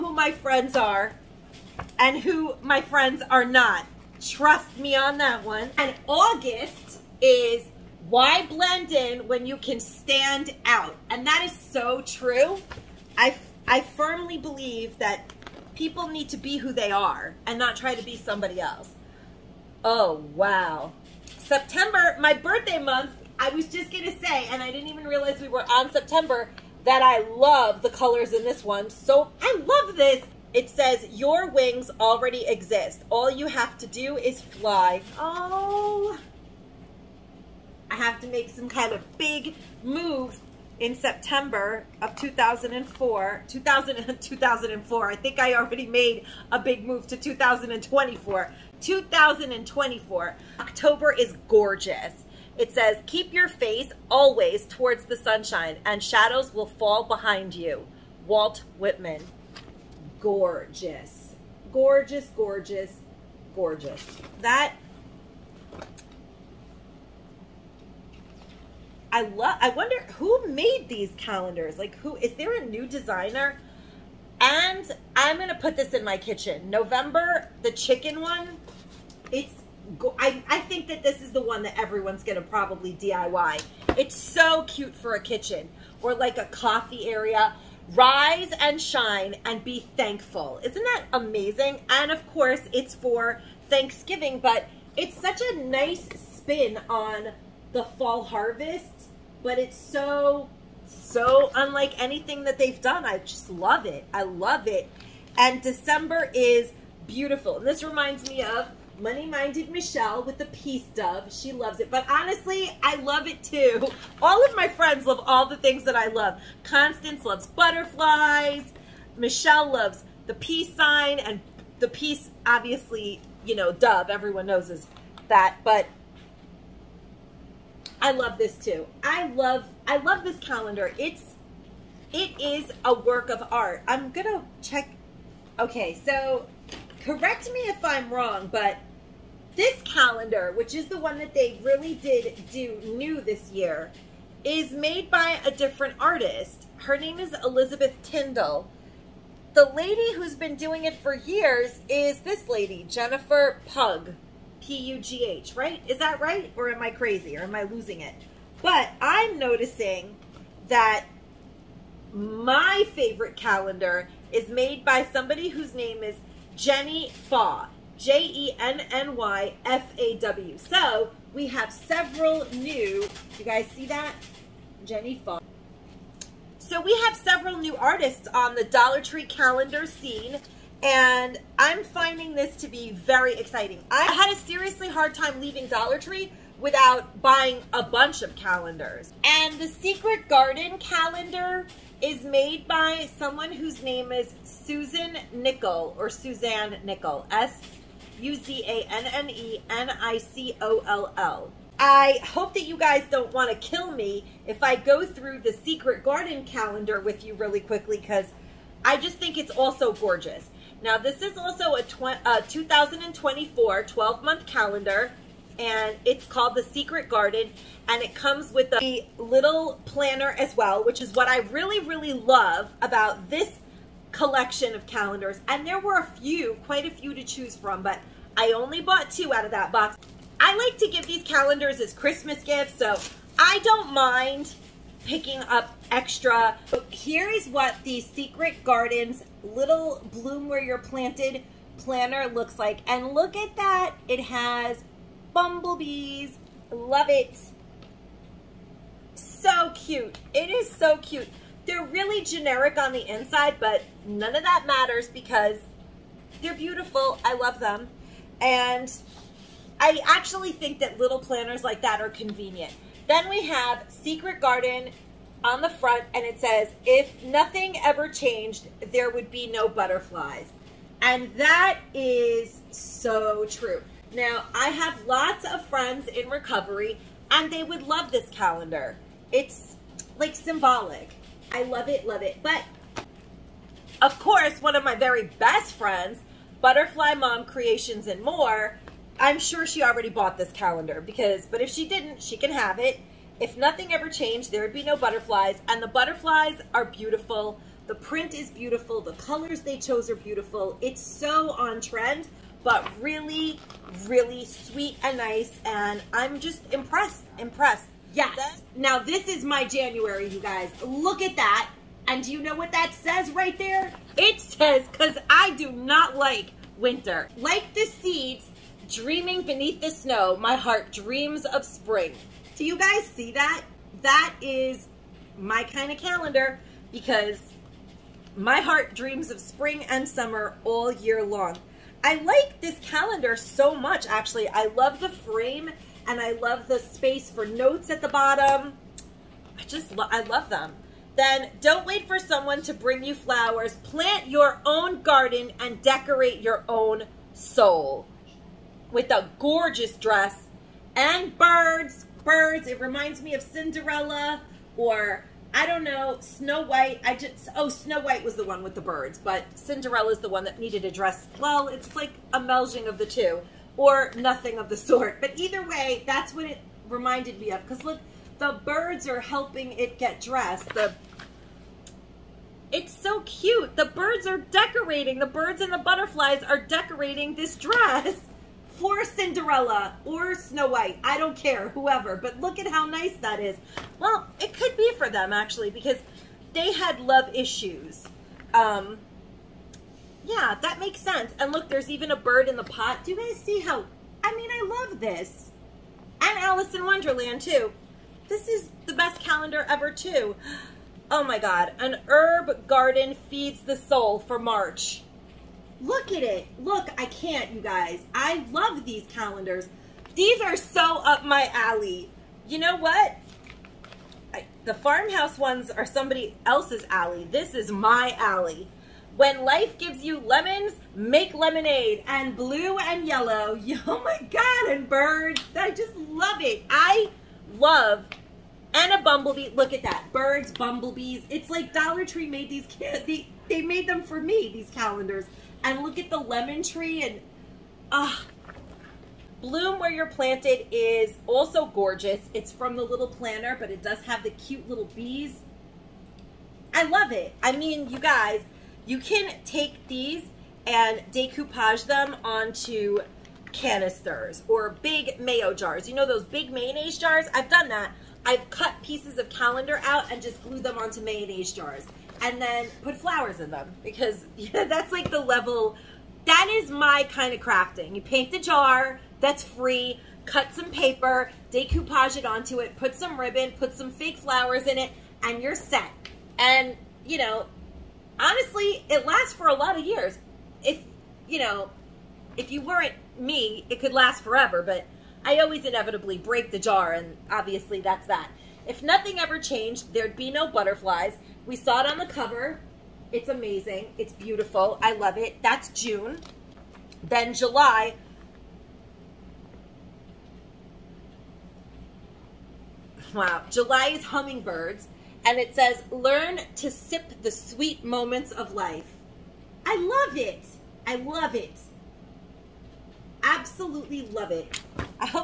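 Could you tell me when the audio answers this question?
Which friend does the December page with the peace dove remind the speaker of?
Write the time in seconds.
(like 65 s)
108 s.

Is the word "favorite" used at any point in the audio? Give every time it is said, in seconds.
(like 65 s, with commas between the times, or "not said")
162 s.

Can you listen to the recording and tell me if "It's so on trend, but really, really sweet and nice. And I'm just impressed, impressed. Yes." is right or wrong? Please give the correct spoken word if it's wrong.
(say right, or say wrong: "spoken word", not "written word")
right.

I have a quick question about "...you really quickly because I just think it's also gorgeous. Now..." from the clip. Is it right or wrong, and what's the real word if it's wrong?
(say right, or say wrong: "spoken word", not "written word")
right.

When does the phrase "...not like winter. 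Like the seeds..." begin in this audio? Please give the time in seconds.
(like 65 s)
315 s.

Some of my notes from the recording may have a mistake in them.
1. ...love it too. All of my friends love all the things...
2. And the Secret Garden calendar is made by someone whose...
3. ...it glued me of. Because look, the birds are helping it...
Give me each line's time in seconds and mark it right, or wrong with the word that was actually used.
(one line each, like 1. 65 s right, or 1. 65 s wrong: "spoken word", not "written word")
1. 112 s right
2. 189 s right
3. 366 s wrong: "reminded", not "glued".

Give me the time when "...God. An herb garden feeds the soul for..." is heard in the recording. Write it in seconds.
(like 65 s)
401 s.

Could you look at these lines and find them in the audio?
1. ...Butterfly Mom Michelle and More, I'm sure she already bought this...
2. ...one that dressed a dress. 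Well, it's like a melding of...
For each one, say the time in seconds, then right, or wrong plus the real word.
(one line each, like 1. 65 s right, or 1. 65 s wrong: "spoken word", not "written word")
1. 286 s wrong: "Creations", not "Michelle"
2. 360 s wrong: "needed", not "dressed".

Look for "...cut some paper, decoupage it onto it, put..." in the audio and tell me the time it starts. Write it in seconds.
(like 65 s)
470 s.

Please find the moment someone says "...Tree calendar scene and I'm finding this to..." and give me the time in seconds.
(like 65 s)
178 s.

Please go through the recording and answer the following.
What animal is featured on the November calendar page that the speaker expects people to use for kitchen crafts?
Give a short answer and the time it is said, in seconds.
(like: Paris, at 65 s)
Chicken, at 77 s.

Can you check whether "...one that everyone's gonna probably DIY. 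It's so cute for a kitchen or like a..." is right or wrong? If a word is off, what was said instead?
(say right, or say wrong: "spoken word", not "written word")
right.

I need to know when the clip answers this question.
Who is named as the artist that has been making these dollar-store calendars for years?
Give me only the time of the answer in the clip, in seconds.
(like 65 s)
152 s.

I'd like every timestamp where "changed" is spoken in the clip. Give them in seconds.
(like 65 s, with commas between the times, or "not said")
268 s, 294 s, 489 s.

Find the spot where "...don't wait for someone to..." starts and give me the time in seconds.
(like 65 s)
341 s.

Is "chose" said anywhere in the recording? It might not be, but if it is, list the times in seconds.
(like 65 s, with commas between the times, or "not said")
299 s.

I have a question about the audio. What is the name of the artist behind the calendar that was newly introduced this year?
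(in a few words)
Elizabeth Tyndall.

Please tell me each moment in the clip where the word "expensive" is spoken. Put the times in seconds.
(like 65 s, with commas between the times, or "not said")
not said.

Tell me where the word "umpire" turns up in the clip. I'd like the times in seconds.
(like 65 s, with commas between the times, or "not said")
not said.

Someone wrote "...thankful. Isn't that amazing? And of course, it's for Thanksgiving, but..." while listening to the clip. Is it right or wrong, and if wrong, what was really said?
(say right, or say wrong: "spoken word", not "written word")
right.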